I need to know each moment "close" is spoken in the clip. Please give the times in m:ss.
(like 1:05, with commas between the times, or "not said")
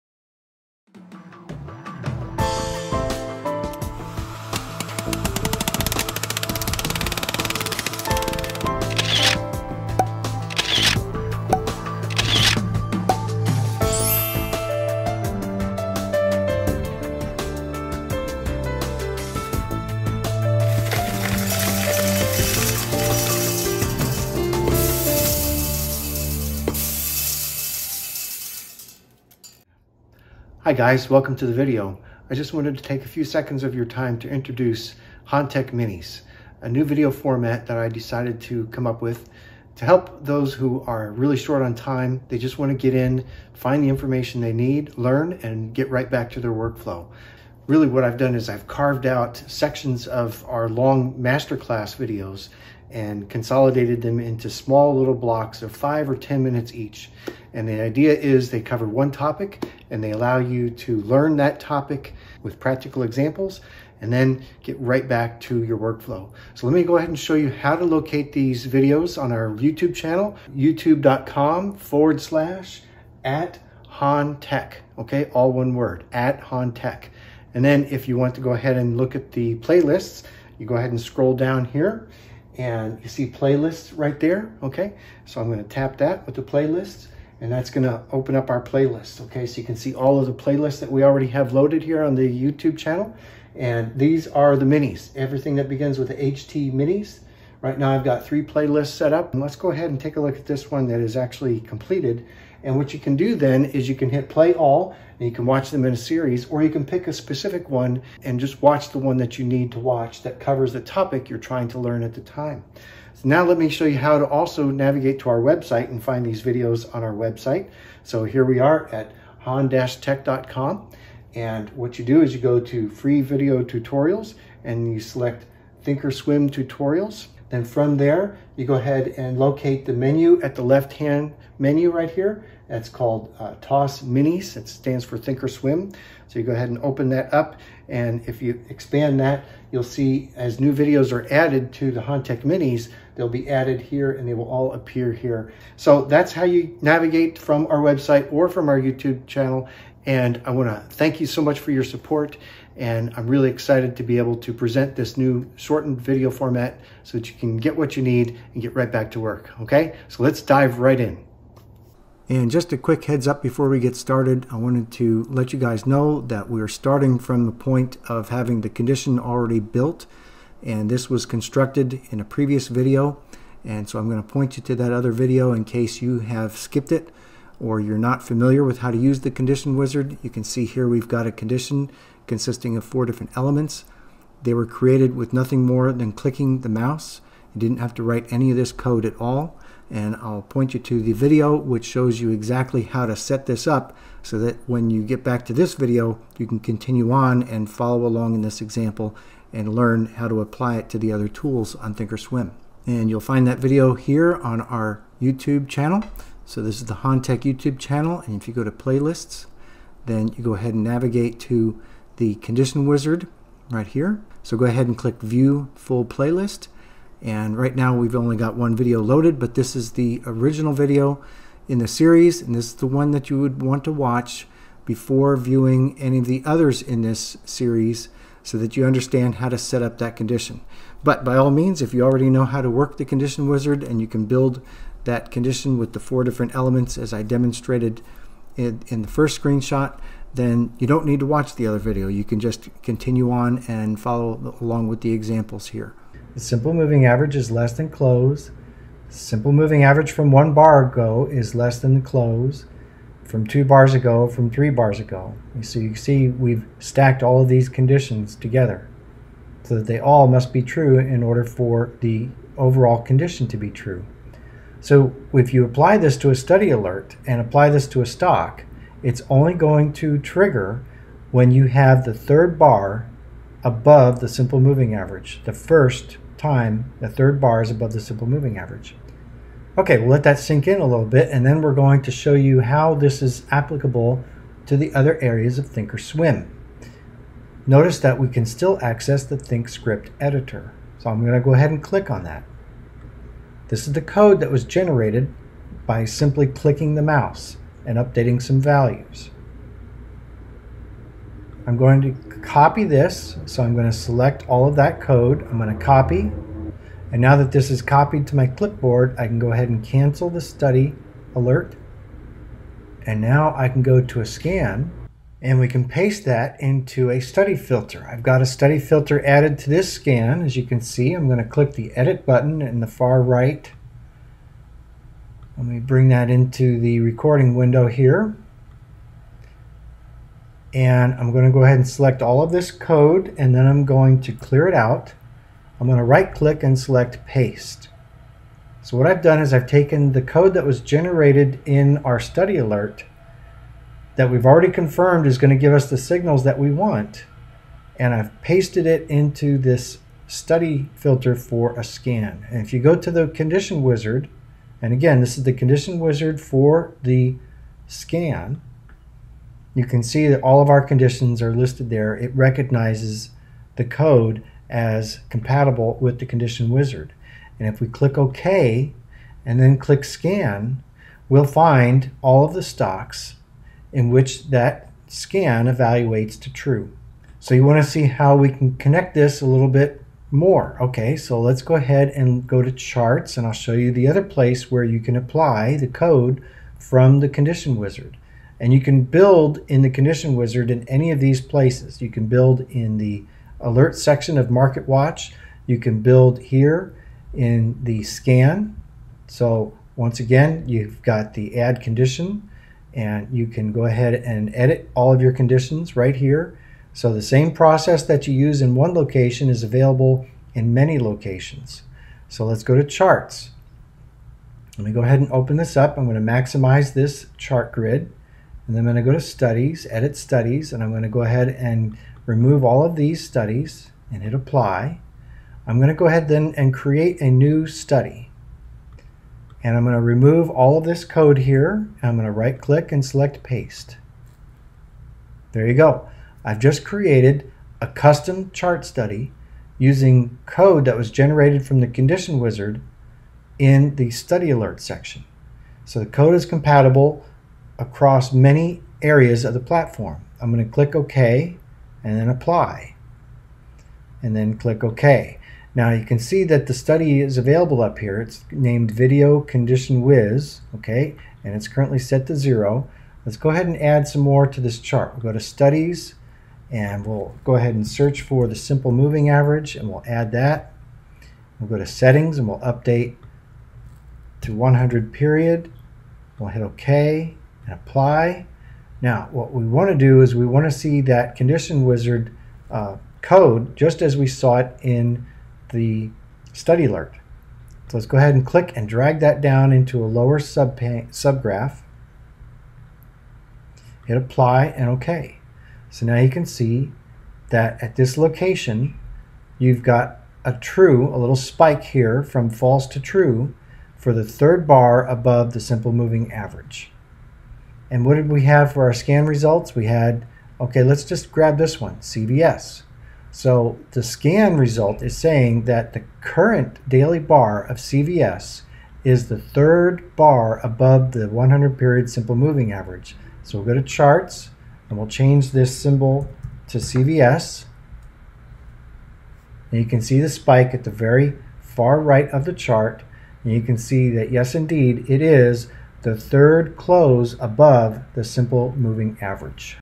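4:07, 4:12, 8:56.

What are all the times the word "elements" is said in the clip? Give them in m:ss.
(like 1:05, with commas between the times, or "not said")
3:03, 3:56.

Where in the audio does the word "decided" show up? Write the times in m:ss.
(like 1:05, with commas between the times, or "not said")
0:37.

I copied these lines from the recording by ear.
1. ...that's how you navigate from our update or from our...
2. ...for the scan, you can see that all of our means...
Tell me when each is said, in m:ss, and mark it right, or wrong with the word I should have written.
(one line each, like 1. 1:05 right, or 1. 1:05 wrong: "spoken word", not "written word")
1. 2:26 wrong: "website", not "update"
2. 5:56 wrong: "conditions", not "means".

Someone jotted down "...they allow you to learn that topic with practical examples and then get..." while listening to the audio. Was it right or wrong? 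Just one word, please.
right.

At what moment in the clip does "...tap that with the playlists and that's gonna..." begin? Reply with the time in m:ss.
1:25.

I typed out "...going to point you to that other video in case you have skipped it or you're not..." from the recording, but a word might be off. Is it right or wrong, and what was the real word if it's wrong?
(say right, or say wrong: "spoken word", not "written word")
right.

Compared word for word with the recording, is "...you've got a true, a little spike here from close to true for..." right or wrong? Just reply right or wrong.
wrong.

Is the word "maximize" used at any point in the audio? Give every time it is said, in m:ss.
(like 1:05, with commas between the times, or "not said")
6:56.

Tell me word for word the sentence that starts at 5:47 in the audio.
And I've pasted it into this study filter for a scan.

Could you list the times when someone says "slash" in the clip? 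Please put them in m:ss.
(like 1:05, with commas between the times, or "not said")
1:12.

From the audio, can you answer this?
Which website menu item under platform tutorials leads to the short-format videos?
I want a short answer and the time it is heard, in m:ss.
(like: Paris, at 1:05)
TOS Minis, at 2:13.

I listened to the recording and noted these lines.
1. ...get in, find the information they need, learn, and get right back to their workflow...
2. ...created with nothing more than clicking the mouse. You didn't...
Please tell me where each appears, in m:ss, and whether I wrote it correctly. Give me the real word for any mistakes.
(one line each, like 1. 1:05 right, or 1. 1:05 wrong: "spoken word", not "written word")
1. 0:42 right
2. 3:04 right.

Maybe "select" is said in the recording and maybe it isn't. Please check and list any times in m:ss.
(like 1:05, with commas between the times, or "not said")
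2:04, 5:03, 5:31, 5:36, 7:13.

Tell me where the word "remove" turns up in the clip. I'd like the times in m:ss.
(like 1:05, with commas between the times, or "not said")
7:02, 7:10.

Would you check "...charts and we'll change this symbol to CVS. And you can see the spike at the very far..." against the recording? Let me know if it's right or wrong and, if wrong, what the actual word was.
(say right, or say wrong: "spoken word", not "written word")
right.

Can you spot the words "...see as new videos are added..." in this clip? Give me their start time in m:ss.
2:19.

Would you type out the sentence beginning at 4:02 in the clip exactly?
You can just continue on and follow along with the examples here.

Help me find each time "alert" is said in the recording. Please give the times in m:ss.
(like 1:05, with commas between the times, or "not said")
4:26, 5:11, 5:42, 6:33, 7:24, 8:06.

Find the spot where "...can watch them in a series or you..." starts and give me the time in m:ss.
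1:45.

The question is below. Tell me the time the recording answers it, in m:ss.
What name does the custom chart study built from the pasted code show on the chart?
7:38.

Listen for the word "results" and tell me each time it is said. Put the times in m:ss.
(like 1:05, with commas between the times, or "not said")
8:29, 8:34.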